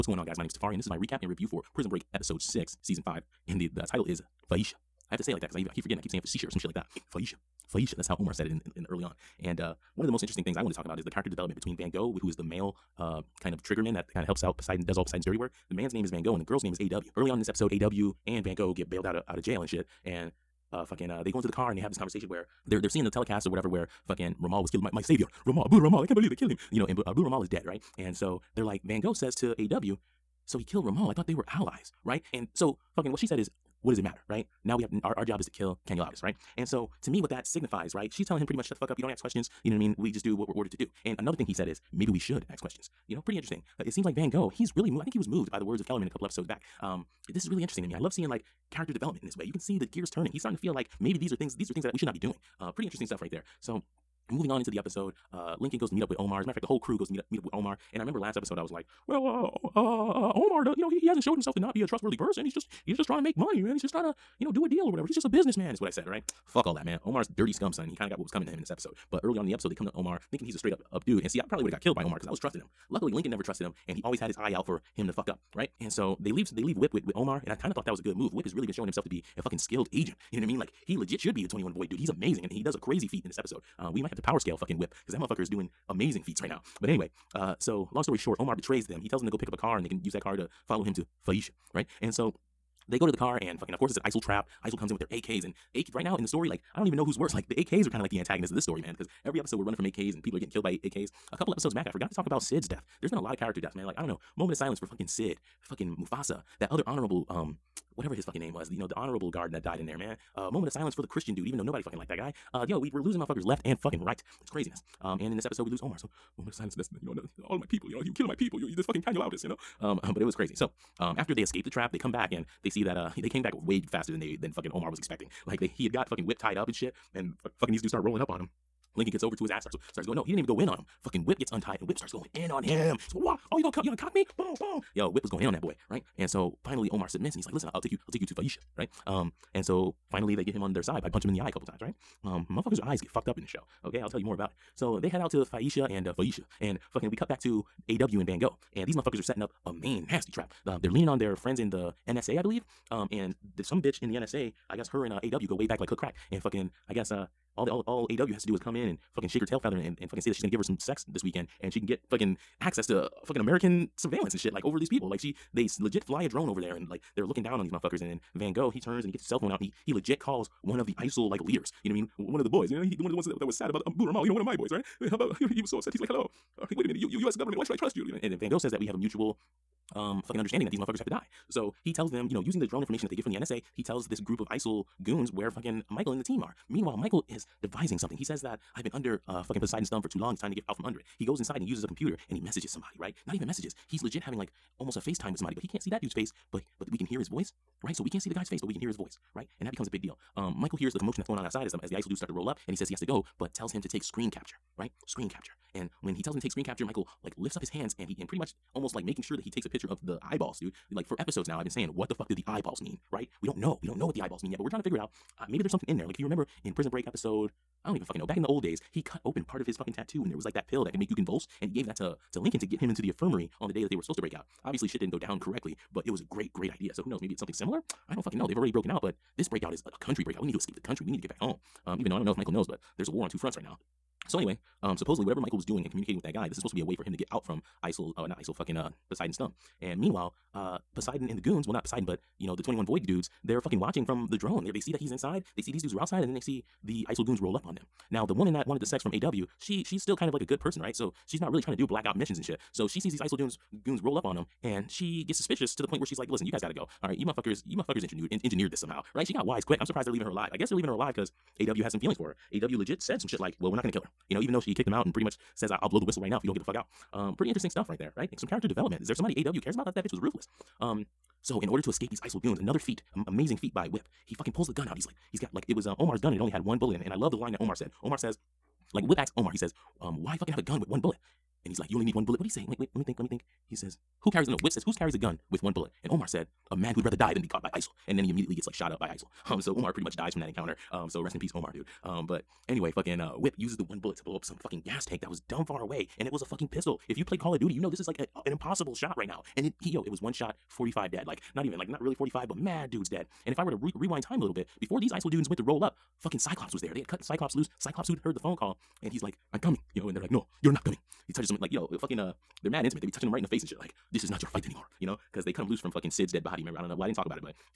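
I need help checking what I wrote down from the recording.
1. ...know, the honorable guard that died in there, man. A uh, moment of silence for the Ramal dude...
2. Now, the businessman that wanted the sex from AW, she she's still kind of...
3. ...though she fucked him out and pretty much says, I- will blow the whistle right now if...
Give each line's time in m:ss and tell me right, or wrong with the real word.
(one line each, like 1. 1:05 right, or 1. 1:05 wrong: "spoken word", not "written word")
1. 1:48 wrong: "Christian", not "Ramal"
2. 4:08 wrong: "woman", not "businessman"
3. 4:24 wrong: "kicked", not "fucked".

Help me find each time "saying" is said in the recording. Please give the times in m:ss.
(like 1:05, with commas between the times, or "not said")
0:06, 3:31.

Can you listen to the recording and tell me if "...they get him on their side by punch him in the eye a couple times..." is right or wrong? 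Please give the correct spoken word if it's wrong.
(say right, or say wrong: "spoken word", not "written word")
right.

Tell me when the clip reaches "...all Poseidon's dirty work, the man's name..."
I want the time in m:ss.
0:14.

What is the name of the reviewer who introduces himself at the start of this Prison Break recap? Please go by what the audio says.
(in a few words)
Tafari.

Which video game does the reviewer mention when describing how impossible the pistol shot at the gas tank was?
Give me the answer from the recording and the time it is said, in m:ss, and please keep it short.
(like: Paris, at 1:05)
Call of Duty, at 4:57.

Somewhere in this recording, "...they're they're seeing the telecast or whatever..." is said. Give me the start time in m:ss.
0:22.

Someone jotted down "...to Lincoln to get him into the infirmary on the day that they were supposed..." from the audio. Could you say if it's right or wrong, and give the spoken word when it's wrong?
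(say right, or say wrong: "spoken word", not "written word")
right.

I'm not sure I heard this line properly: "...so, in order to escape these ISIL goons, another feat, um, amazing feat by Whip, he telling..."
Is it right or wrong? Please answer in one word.
wrong.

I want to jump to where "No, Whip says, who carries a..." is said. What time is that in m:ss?
4:44.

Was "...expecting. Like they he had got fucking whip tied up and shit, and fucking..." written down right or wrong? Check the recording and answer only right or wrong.
right.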